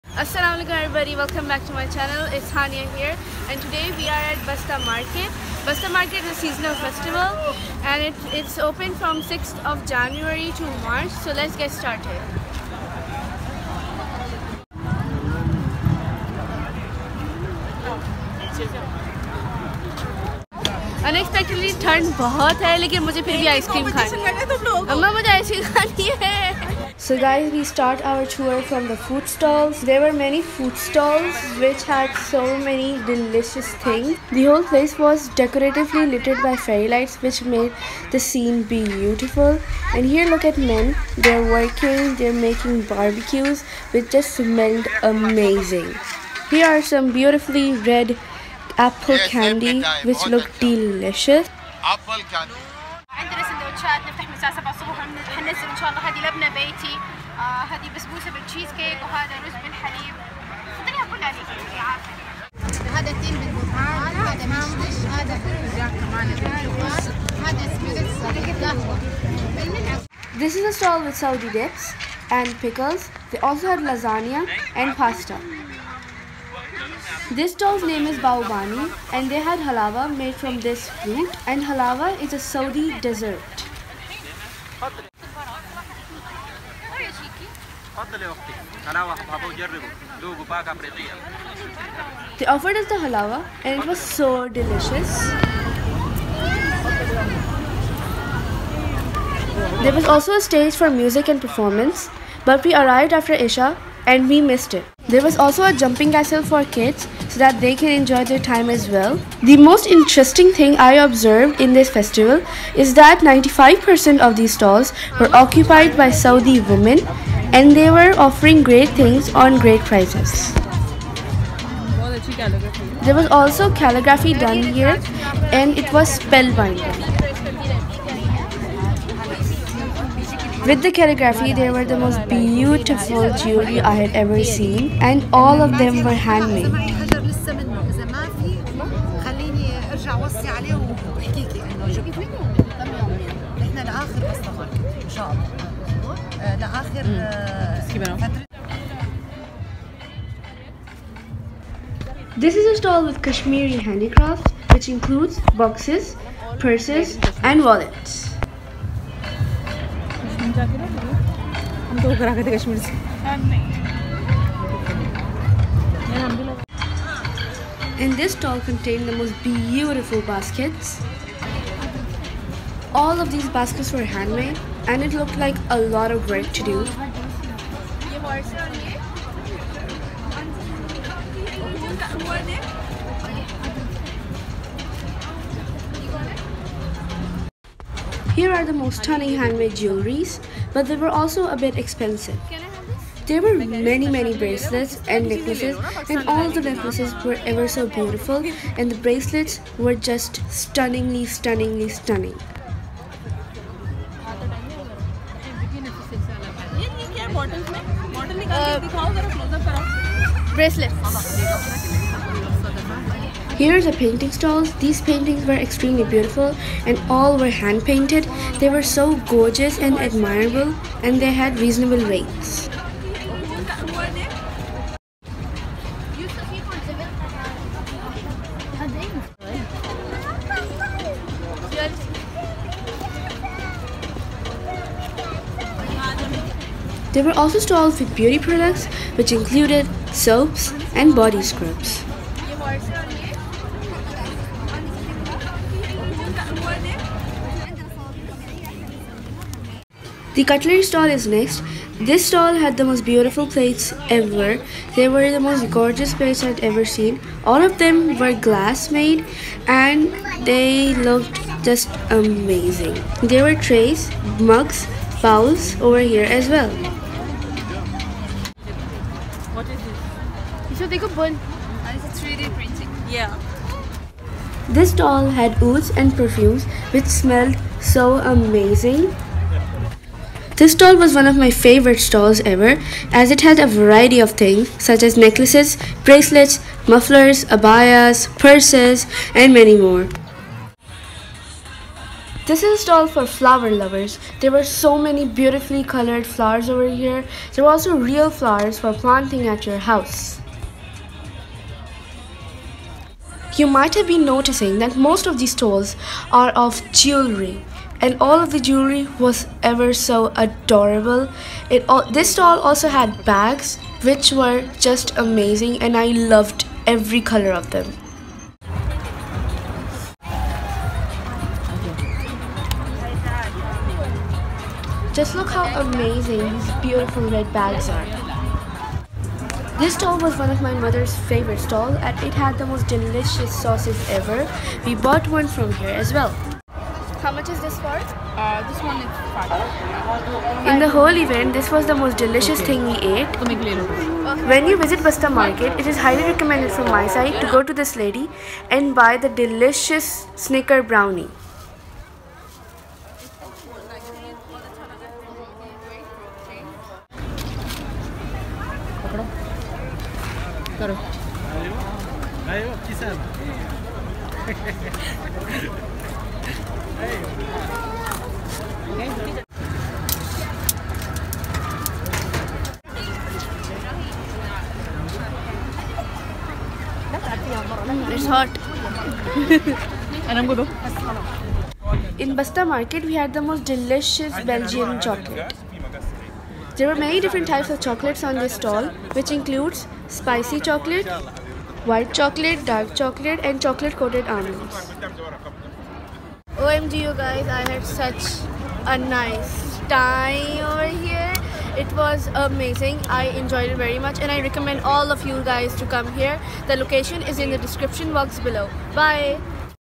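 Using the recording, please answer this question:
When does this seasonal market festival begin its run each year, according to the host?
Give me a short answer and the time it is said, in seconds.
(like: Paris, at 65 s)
6th of January, at 9 s.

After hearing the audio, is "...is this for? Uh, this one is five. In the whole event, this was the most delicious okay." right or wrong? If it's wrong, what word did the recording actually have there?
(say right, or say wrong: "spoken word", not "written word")
right.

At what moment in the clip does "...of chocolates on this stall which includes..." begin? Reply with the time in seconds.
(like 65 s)
387 s.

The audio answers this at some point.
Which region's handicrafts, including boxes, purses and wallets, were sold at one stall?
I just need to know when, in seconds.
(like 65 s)
153 s.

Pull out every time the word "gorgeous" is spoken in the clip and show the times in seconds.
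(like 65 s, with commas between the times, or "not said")
219 s, 255 s.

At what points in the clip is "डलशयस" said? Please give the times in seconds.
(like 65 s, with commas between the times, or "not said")
383 s.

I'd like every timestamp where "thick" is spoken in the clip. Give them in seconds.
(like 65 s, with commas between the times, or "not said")
not said.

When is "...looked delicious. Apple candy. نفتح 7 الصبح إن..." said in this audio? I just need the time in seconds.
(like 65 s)
50 s.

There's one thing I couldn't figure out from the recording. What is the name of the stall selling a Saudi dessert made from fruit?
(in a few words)
Baobani.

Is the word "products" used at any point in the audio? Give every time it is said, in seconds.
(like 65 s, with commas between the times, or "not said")
238 s.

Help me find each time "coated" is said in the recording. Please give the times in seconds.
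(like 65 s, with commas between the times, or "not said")
393 s.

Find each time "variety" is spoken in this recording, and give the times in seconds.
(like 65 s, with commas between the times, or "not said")
283 s.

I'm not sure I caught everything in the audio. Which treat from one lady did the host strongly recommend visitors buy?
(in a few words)
Snicker brownie.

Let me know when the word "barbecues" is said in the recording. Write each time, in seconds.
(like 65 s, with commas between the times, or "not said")
42 s.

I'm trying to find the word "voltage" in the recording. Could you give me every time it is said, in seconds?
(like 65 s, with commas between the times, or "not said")
not said.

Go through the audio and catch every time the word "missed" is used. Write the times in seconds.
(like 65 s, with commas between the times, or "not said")
104 s.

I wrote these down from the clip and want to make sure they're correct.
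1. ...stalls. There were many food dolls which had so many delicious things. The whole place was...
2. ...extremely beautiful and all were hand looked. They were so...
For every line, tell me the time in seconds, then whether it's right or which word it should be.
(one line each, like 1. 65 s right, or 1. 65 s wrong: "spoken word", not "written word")
1. 29 s wrong: "stalls", not "dolls"
2. 215 s wrong: "painted", not "looked".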